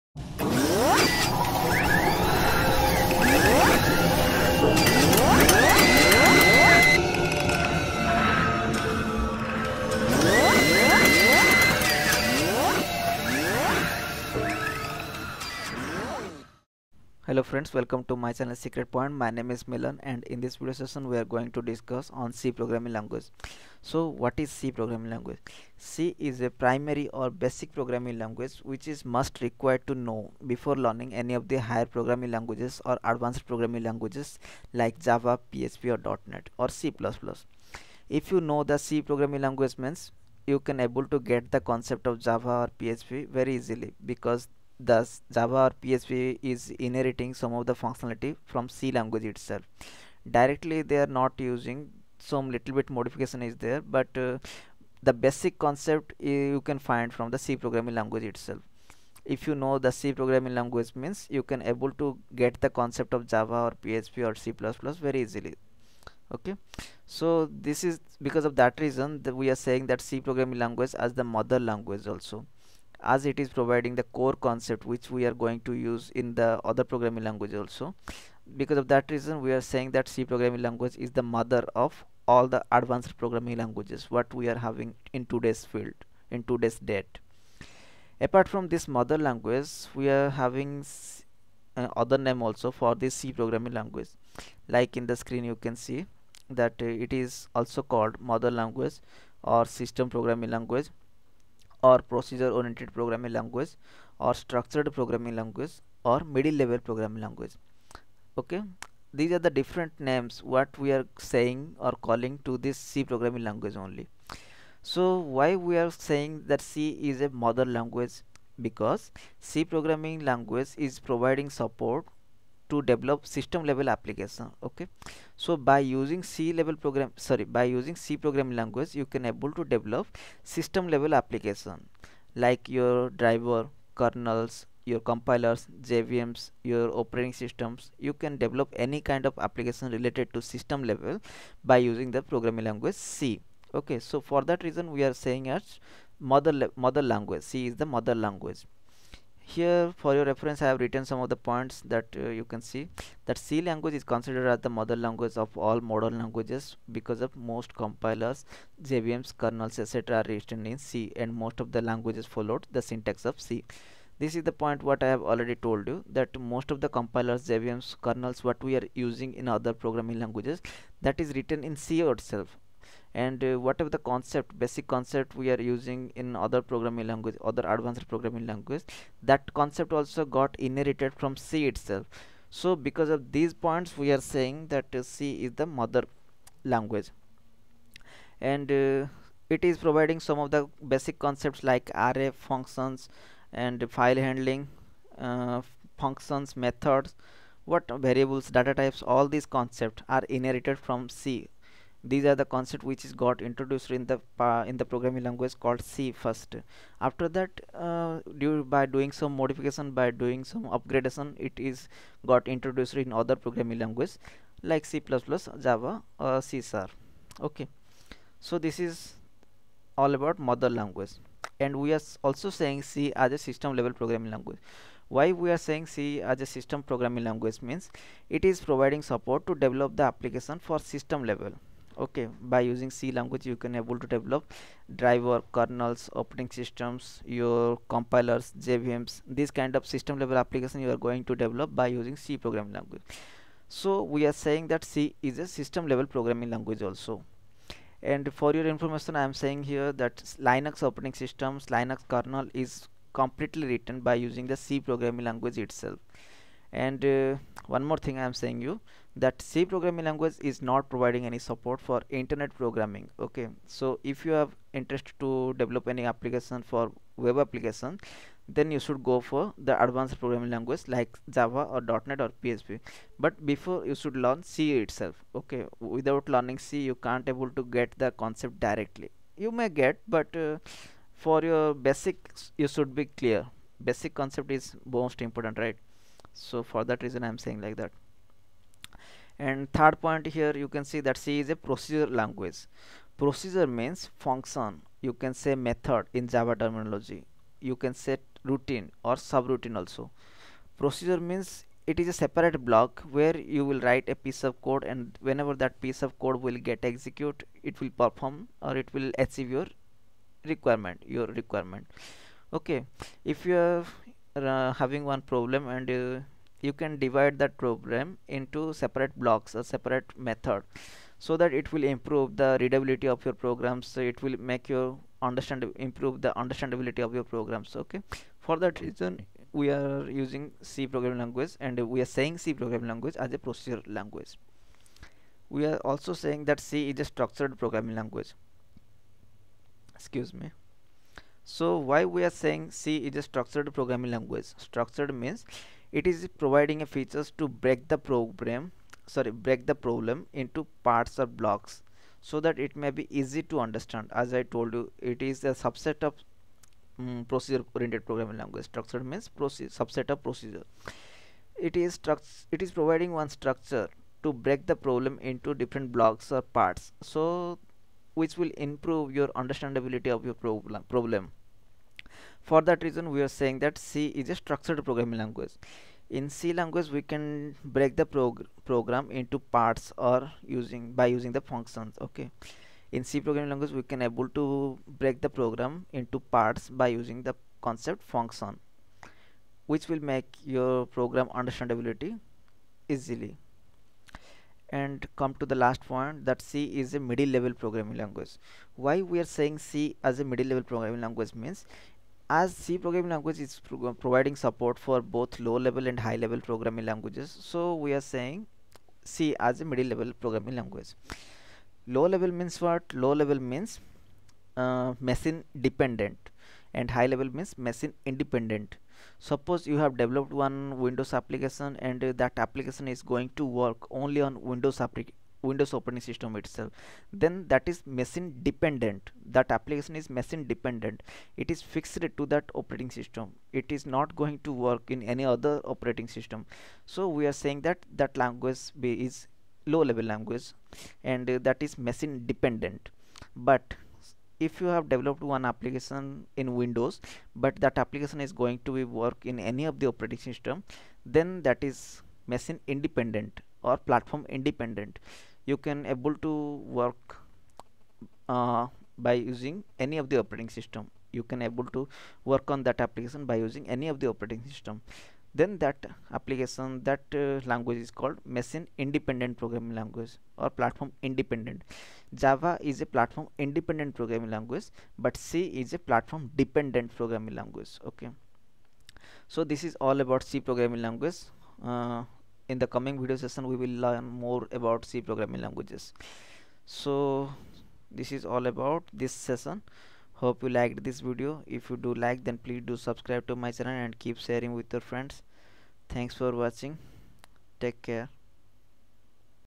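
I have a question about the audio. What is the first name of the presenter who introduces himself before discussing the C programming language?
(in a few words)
Milan.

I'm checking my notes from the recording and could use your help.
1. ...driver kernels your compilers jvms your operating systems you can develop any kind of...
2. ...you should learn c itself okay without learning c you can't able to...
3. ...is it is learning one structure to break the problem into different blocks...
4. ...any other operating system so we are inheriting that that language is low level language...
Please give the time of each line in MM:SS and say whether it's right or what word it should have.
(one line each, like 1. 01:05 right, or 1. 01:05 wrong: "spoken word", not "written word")
1. 02:13 right
2. 04:33 right
3. 06:01 wrong: "providing", not "learning"
4. 07:15 wrong: "saying", not "inheriting".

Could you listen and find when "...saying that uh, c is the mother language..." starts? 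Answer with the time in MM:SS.
03:04.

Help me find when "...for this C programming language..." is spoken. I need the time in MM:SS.
01:32.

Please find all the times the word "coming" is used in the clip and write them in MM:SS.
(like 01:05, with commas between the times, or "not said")
08:02.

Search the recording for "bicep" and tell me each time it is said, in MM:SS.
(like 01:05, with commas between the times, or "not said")
not said.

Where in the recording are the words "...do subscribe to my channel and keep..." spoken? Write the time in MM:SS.
08:12.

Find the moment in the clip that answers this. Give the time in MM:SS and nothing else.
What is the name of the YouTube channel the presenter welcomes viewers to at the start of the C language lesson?
00:18.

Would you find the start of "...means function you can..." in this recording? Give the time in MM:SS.
04:53.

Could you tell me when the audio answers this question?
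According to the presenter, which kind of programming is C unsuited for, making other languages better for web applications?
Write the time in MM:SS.
04:22.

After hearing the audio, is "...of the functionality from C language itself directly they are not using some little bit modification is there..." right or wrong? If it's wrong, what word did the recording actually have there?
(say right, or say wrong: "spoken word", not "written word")
right.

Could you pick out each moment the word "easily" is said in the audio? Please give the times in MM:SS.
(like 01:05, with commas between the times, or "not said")
00:43, 01:05, 06:32.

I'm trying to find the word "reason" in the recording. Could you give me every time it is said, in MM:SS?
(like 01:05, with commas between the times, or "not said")
01:08, 01:19, 02:24, 04:47, 05:28, 06:12.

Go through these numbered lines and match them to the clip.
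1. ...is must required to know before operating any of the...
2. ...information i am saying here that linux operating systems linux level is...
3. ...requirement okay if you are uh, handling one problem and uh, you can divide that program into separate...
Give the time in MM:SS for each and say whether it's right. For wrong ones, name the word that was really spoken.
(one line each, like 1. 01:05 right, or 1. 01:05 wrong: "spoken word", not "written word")
1. 00:28 wrong: "learning", not "operating"
2. 04:08 wrong: "kernel", not "level"
3. 05:11 wrong: "having", not "handling".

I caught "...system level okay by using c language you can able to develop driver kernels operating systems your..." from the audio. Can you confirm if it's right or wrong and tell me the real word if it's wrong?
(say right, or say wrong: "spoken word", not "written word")
right.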